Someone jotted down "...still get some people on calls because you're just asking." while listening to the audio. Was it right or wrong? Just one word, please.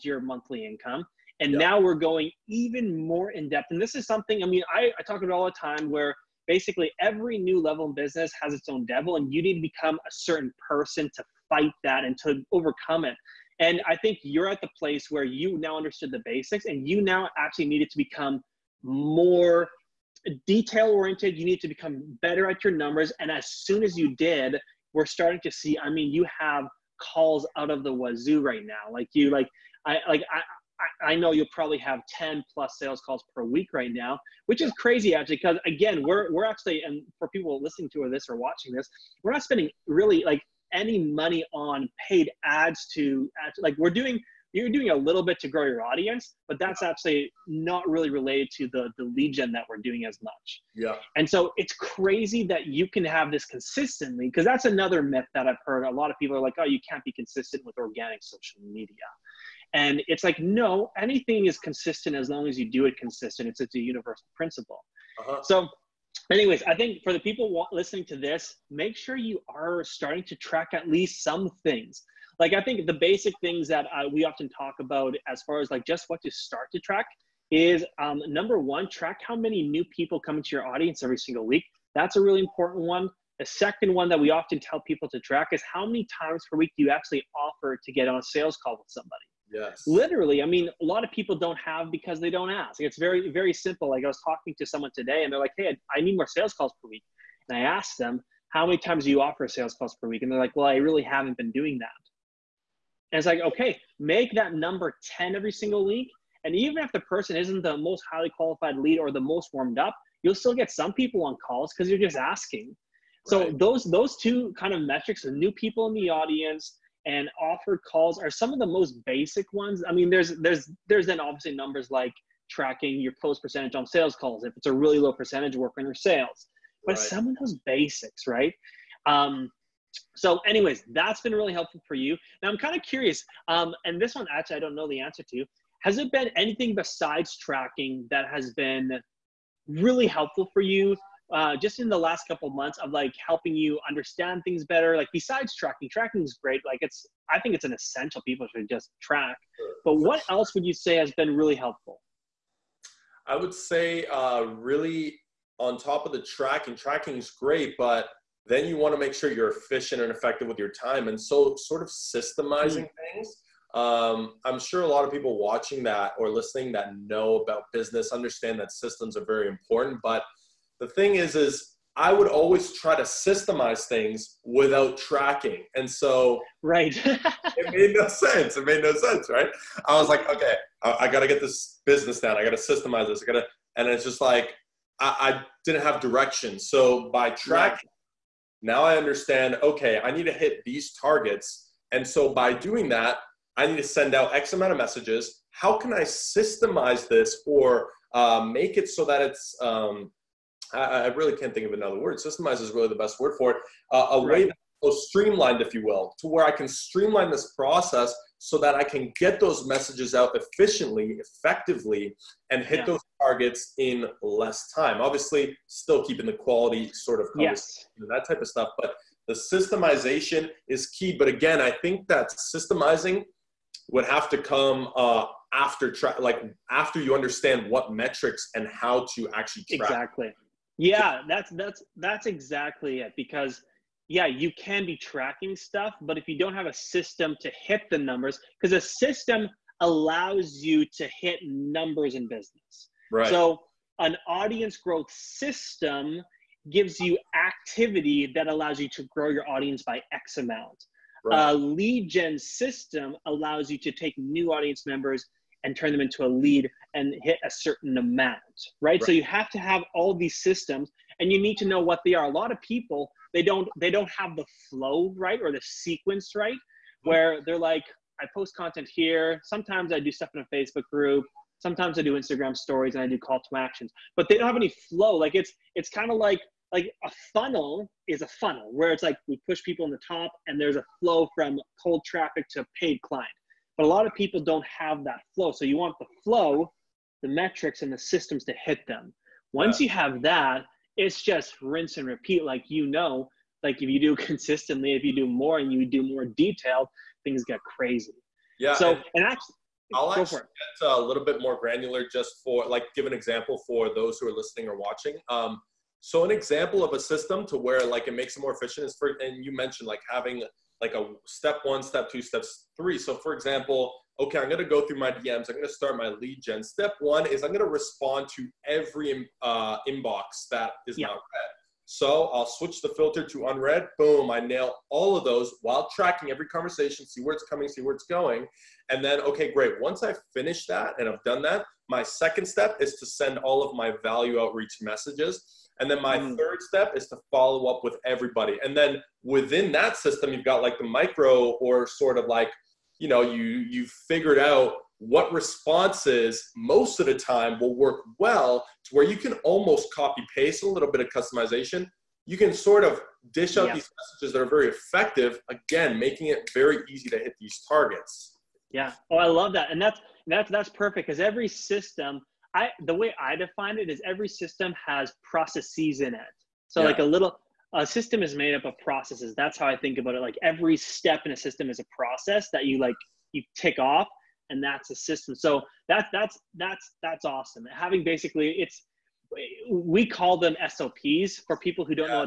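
right.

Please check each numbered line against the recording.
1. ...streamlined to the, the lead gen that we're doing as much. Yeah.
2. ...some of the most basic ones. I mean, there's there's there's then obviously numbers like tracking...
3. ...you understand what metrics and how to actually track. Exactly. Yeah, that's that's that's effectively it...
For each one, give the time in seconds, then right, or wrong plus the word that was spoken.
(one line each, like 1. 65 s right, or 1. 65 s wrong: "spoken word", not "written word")
1. 48 s wrong: "related", not "streamlined"
2. 118 s right
3. 227 s wrong: "exactly", not "effectively".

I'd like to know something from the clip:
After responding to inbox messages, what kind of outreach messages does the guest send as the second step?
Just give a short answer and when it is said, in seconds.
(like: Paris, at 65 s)
value outreach messages, at 334 s.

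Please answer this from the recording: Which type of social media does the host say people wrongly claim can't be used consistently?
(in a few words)
organic social media.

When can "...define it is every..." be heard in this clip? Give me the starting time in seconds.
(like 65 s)
363 s.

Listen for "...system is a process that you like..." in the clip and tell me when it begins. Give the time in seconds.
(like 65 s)
371 s.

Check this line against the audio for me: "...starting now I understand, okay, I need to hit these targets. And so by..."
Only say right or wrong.
wrong.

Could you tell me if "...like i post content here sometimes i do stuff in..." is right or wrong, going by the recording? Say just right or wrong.
right.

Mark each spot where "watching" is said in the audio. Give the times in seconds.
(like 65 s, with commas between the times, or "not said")
38 s, 165 s, 304 s.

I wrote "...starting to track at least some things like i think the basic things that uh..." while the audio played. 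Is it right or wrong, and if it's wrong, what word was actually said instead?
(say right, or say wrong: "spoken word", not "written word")
right.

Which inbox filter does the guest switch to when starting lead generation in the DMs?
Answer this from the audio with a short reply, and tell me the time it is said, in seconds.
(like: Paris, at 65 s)
unread, at 323 s.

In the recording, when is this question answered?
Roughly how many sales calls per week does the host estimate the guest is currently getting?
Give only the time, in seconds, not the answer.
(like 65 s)
32 s.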